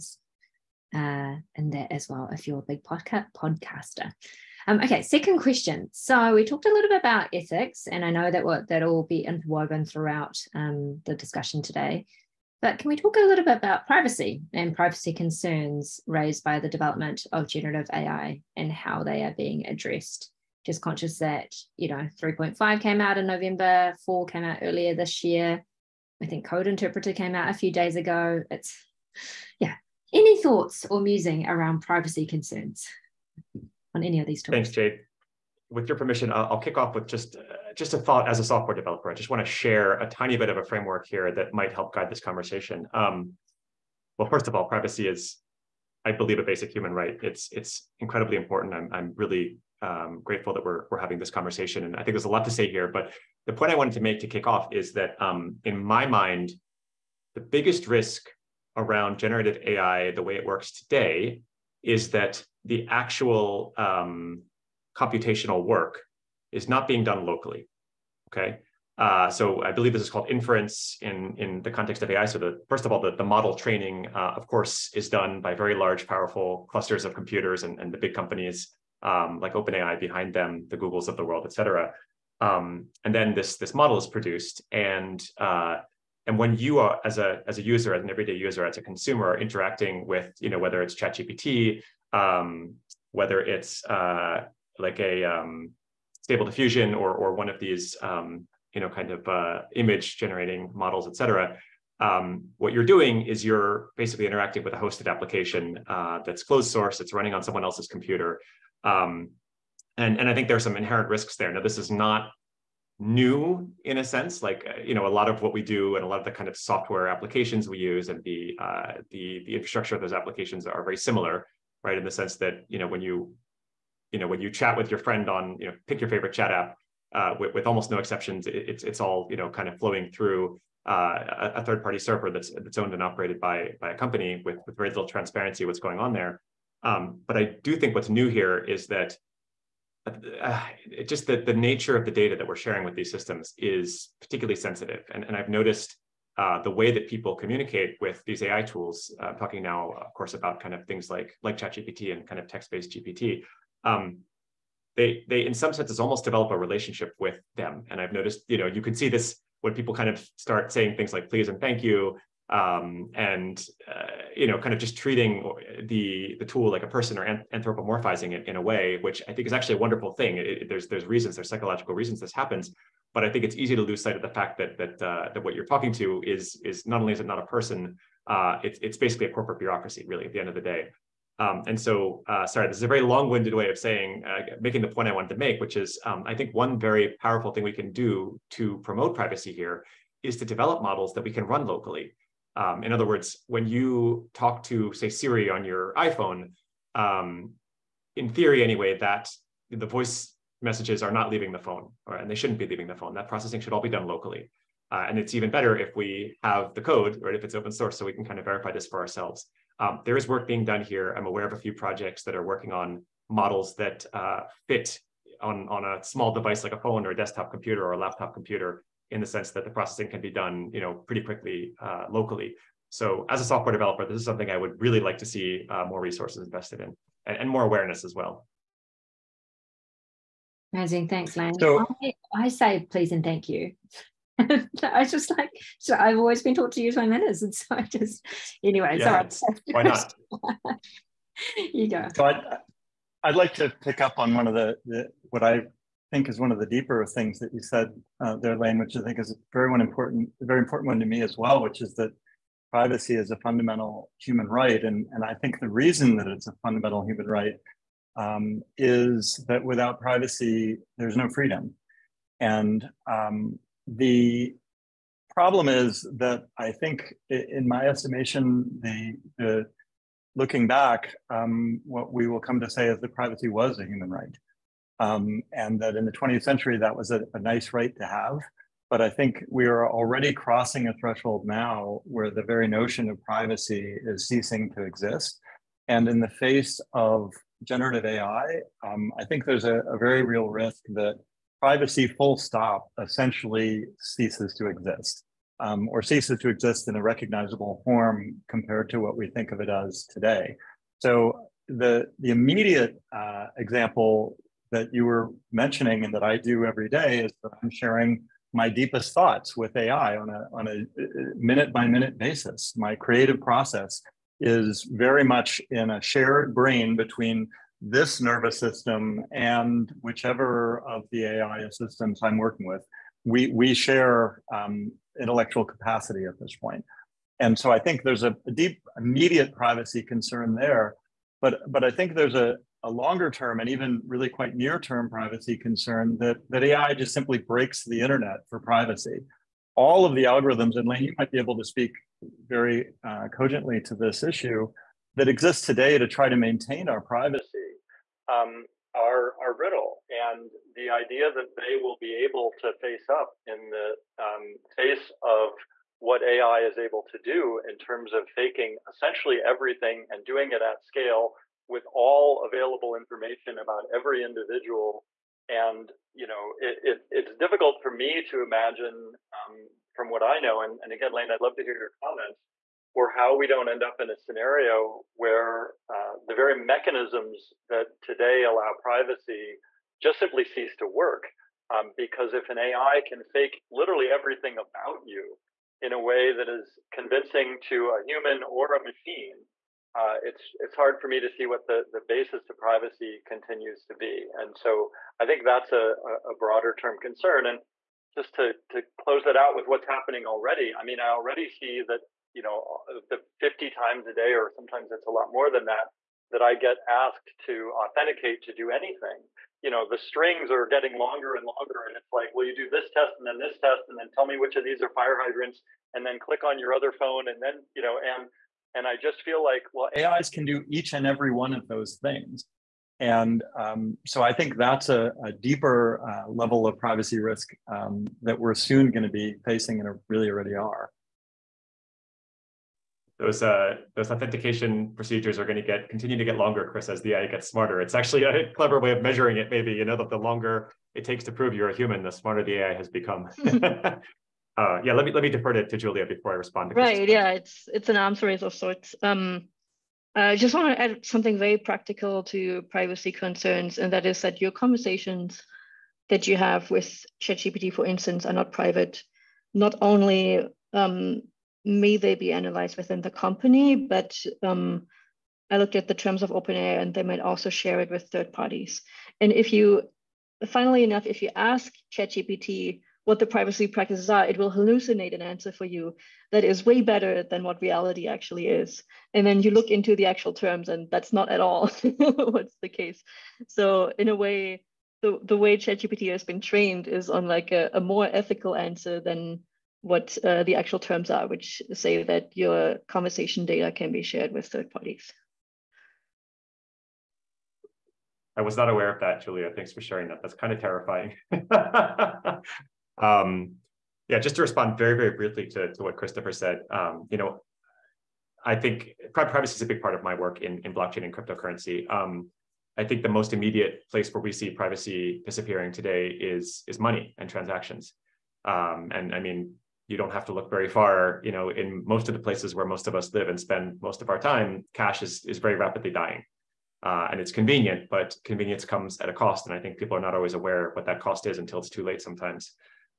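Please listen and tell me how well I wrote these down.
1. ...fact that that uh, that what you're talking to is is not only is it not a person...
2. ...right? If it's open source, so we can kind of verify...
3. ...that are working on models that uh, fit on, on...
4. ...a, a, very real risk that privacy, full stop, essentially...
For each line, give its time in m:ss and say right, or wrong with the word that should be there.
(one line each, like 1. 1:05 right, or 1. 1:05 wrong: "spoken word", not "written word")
1. 2:54 right
2. 3:27 right
3. 3:32 right
4. 4:49 right.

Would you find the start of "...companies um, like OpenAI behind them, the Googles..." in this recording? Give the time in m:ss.
1:18.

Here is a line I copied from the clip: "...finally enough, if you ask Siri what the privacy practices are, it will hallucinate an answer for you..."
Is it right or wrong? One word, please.
wrong.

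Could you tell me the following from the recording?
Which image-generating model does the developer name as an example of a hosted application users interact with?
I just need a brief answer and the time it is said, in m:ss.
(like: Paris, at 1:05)
Stable Diffusion, at 1:36.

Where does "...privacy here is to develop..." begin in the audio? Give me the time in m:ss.
3:09.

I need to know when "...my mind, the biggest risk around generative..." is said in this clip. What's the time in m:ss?
0:55.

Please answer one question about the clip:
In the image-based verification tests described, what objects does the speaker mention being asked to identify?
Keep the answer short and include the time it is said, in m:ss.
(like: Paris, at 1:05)
Fire hydrants, at 6:54.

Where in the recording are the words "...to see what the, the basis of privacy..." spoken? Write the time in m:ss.
6:31.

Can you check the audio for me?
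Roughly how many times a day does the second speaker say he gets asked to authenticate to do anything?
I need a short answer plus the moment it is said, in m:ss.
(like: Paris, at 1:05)
50, at 6:43.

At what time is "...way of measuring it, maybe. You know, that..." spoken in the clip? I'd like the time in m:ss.
7:18.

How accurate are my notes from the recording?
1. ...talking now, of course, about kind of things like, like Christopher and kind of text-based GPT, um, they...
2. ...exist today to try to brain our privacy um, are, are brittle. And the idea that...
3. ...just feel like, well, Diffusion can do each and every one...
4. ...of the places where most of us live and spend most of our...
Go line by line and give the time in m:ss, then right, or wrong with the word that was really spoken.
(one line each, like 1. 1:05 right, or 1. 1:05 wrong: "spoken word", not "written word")
1. 2:29 wrong: "ChatGPT", not "Christopher"
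2. 5:45 wrong: "maintain", not "brain"
3. 6:58 wrong: "AIs", not "Diffusion"
4. 8:42 right.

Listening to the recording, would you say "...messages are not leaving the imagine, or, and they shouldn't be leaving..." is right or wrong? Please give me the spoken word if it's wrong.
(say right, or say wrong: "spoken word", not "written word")
wrong: "phone", not "imagine".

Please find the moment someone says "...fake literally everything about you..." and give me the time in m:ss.
6:23.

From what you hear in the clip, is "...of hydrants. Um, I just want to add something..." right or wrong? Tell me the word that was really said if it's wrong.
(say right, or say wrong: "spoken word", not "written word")
wrong: "sorts", not "hydrants".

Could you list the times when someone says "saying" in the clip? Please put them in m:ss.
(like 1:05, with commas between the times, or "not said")
2:40, 3:03.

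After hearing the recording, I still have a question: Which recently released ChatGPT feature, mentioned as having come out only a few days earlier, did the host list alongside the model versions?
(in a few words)
Code interpreter.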